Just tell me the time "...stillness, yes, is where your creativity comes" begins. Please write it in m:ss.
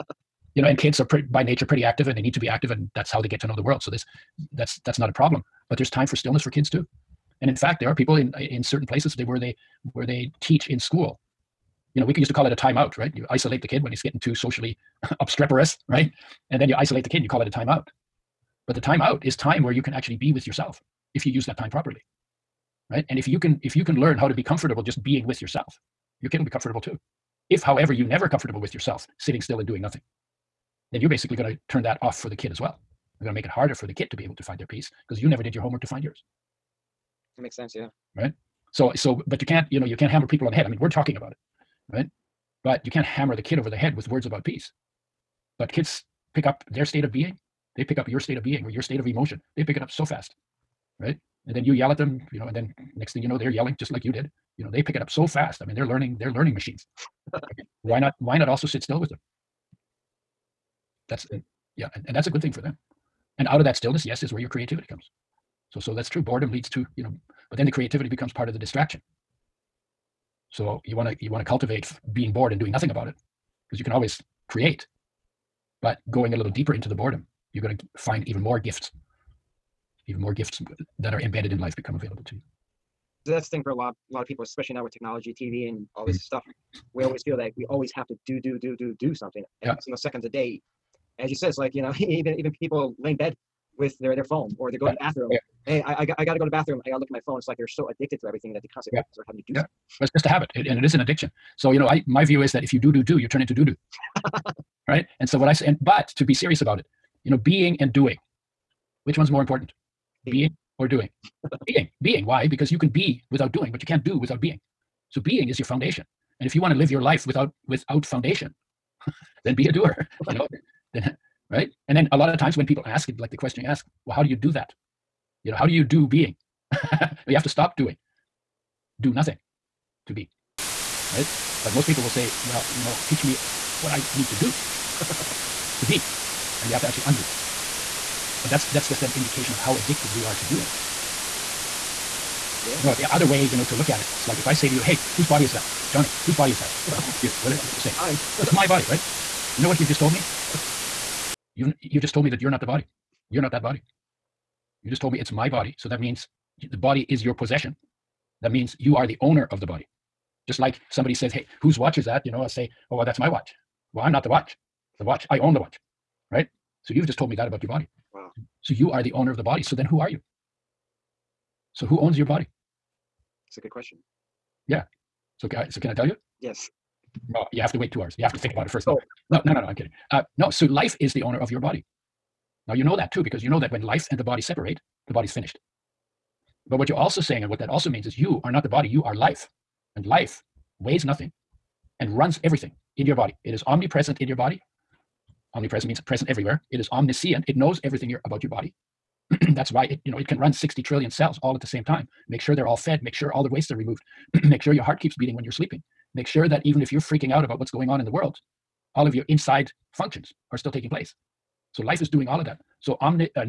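1:03.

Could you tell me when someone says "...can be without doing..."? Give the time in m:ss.
1:52.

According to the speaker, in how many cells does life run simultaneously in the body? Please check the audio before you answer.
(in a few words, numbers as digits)
60 trillion.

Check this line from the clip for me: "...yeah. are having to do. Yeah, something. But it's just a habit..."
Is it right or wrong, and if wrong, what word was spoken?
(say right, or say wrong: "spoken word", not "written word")
right.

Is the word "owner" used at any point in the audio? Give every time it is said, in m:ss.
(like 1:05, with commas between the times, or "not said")
2:39, 2:49, 3:01.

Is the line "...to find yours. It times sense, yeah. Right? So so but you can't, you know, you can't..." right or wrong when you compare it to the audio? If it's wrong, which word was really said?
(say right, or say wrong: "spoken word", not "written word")
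wrong: "makes", not "times".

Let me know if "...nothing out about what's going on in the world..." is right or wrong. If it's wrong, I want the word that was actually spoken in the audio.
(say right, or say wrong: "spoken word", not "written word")
wrong: "freaking", not "nothing".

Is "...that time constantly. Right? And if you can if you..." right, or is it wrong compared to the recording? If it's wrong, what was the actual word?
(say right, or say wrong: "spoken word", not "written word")
wrong: "properly", not "constantly".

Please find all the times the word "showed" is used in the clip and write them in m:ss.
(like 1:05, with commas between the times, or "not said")
not said.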